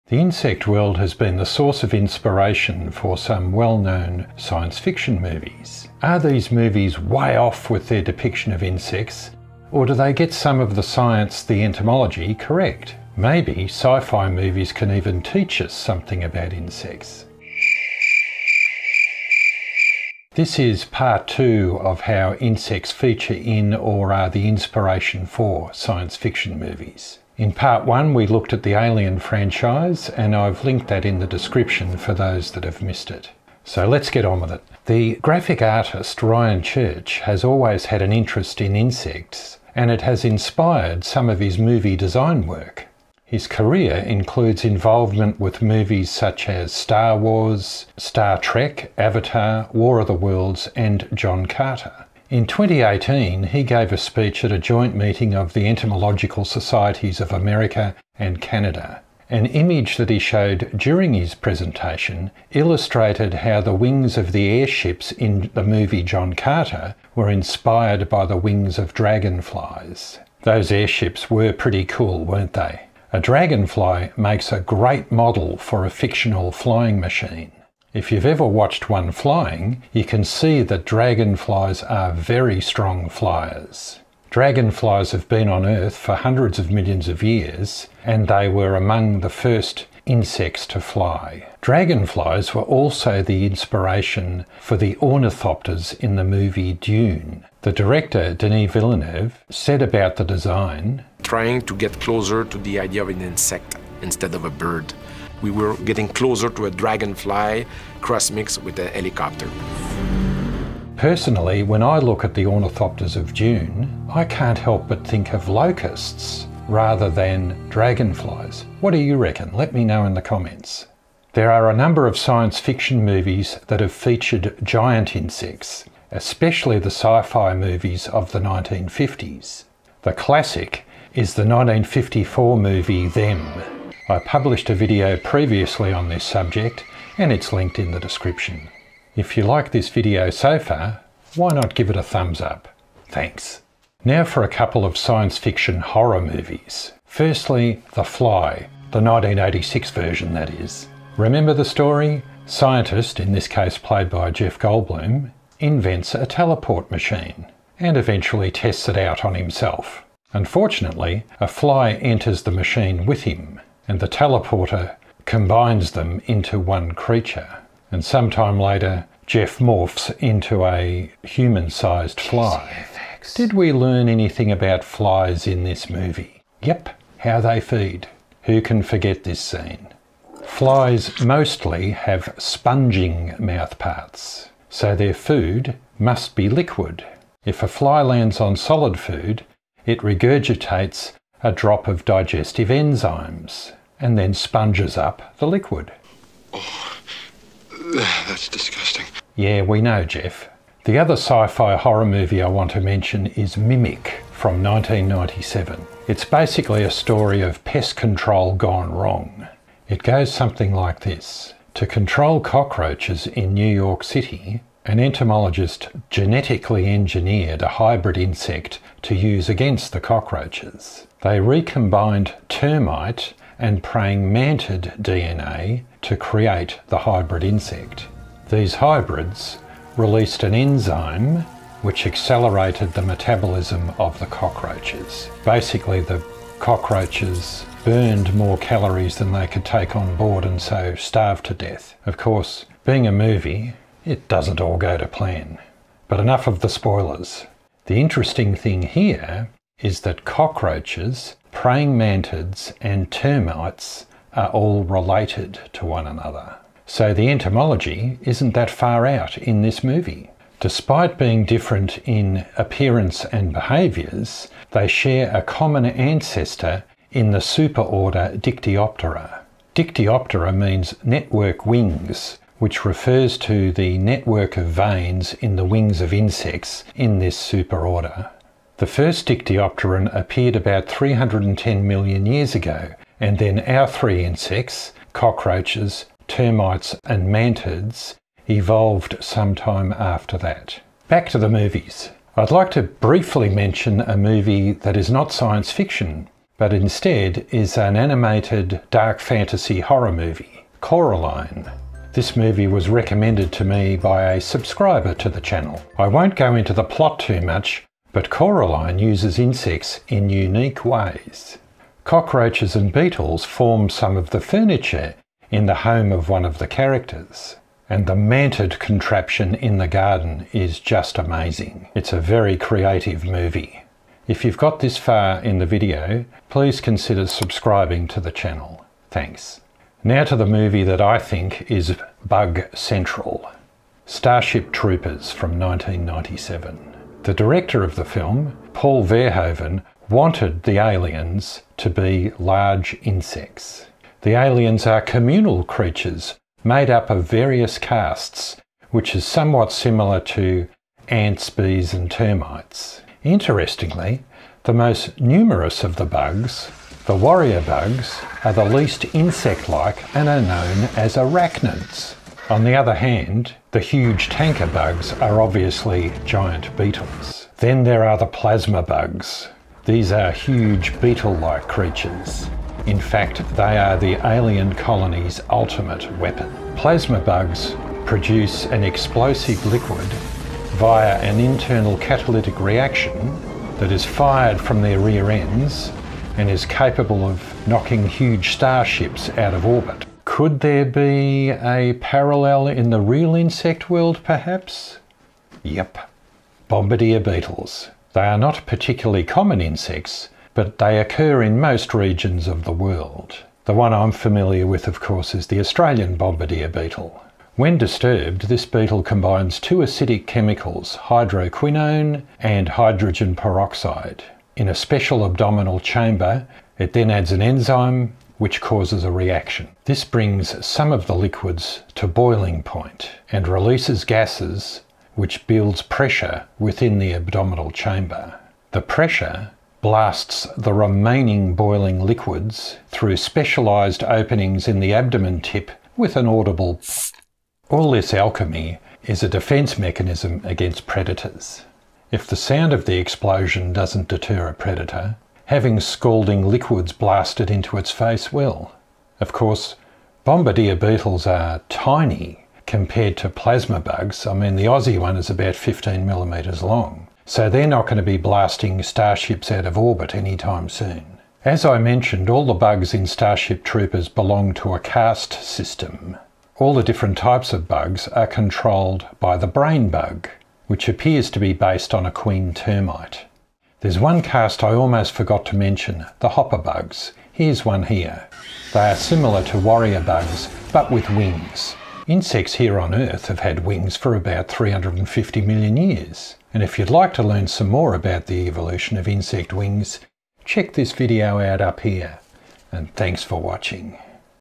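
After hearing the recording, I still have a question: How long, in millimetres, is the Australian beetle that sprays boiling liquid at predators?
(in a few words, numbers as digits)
15.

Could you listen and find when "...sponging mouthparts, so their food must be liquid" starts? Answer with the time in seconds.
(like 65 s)
182 s.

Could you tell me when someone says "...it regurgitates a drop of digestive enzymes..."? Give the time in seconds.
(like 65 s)
189 s.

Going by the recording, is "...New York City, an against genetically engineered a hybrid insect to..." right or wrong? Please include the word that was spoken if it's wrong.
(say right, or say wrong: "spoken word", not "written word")
wrong: "entomologist", not "against".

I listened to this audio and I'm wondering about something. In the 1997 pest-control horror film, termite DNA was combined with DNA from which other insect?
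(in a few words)
praying mantid.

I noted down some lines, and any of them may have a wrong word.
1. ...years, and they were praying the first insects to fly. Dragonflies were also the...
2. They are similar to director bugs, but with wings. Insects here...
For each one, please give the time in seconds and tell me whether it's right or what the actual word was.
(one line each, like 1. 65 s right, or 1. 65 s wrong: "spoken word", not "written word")
1. 87 s wrong: "among", not "praying"
2. 478 s wrong: "warrior", not "director".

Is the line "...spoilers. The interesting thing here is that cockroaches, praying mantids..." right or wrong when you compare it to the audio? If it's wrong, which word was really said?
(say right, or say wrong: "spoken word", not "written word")
right.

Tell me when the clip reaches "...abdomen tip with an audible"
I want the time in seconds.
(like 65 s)
434 s.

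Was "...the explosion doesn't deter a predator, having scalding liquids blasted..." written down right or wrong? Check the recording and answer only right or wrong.
right.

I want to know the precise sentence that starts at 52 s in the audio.
In 2018, he gave a speech at a joint meeting of the Entomological Societies of America and Canada.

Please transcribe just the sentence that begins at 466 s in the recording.
All the different types of bugs are controlled by the brain bug which appears to be based on a queen termite.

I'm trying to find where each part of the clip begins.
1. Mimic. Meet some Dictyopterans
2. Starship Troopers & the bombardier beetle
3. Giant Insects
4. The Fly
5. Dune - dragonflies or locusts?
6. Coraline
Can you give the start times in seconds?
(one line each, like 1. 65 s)
1. 201 s
2. 330 s
3. 121 s
4. 147 s
5. 91 s
6. 291 s.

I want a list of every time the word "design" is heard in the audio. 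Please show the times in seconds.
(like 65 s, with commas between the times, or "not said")
41 s, 100 s.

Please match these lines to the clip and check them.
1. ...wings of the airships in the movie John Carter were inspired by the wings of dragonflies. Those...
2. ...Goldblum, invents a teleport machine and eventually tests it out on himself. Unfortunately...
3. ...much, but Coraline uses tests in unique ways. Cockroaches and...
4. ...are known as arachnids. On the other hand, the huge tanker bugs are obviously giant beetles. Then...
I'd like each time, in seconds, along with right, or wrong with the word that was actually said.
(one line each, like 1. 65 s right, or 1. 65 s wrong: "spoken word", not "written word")
1. 63 s right
2. 154 s right
3. 307 s wrong: "insects", not "tests"
4. 360 s right.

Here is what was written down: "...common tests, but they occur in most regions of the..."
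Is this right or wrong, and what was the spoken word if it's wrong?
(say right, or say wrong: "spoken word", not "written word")
wrong: "insects", not "tests".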